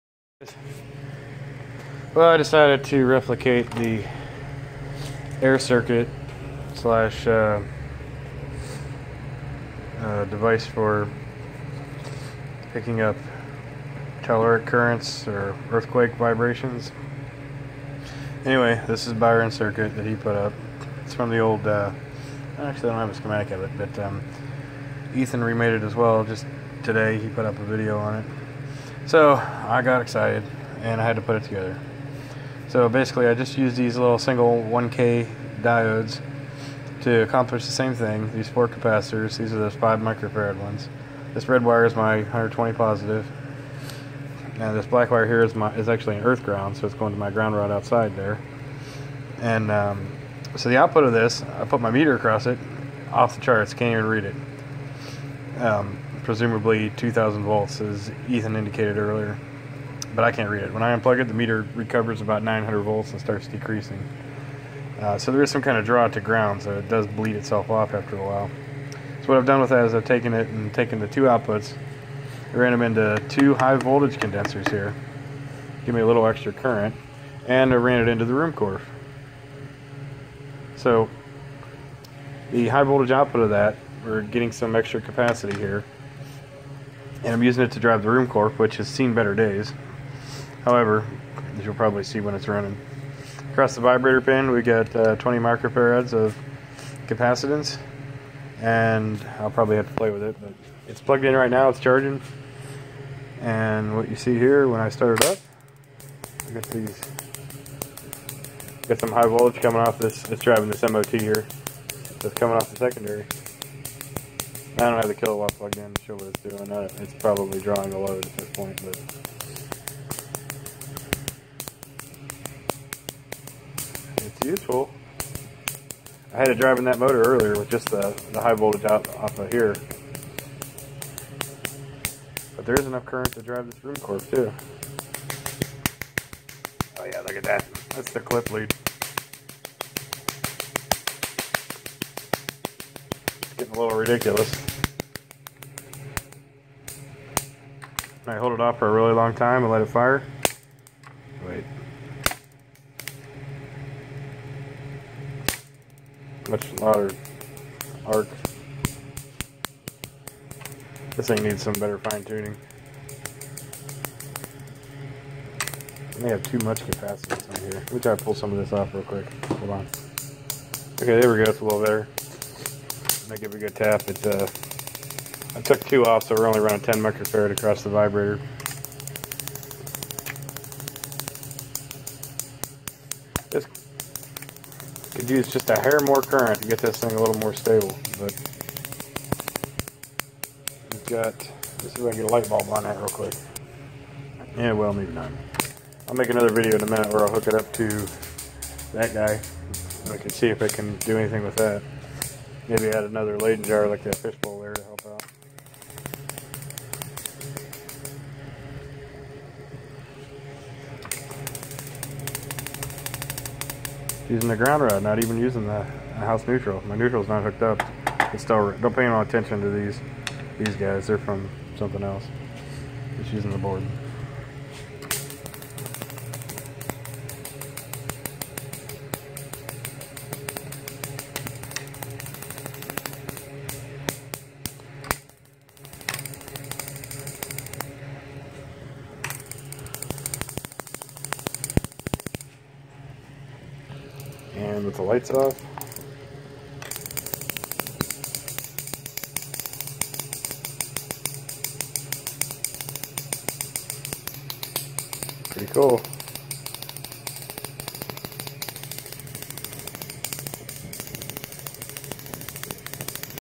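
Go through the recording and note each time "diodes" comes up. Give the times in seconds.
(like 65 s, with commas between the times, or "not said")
35 s.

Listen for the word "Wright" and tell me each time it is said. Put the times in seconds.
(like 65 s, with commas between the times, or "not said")
not said.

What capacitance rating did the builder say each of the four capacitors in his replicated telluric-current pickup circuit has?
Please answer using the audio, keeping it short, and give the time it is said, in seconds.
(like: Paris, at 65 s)
5 microfarads, at 39 s.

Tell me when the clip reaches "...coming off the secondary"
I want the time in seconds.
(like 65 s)
112 s.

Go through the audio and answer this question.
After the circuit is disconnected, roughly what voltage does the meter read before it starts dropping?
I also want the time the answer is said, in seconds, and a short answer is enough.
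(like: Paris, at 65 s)
900 volts, at 62 s.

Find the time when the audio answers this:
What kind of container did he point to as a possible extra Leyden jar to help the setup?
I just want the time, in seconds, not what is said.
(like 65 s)
204 s.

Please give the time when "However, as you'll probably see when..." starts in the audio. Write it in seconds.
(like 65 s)
90 s.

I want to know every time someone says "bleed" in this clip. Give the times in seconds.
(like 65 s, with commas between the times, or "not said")
67 s.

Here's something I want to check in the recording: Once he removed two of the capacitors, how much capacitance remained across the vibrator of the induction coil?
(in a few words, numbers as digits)
10 microfarads.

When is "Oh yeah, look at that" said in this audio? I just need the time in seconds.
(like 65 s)
136 s.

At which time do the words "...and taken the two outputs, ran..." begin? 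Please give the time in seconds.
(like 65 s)
70 s.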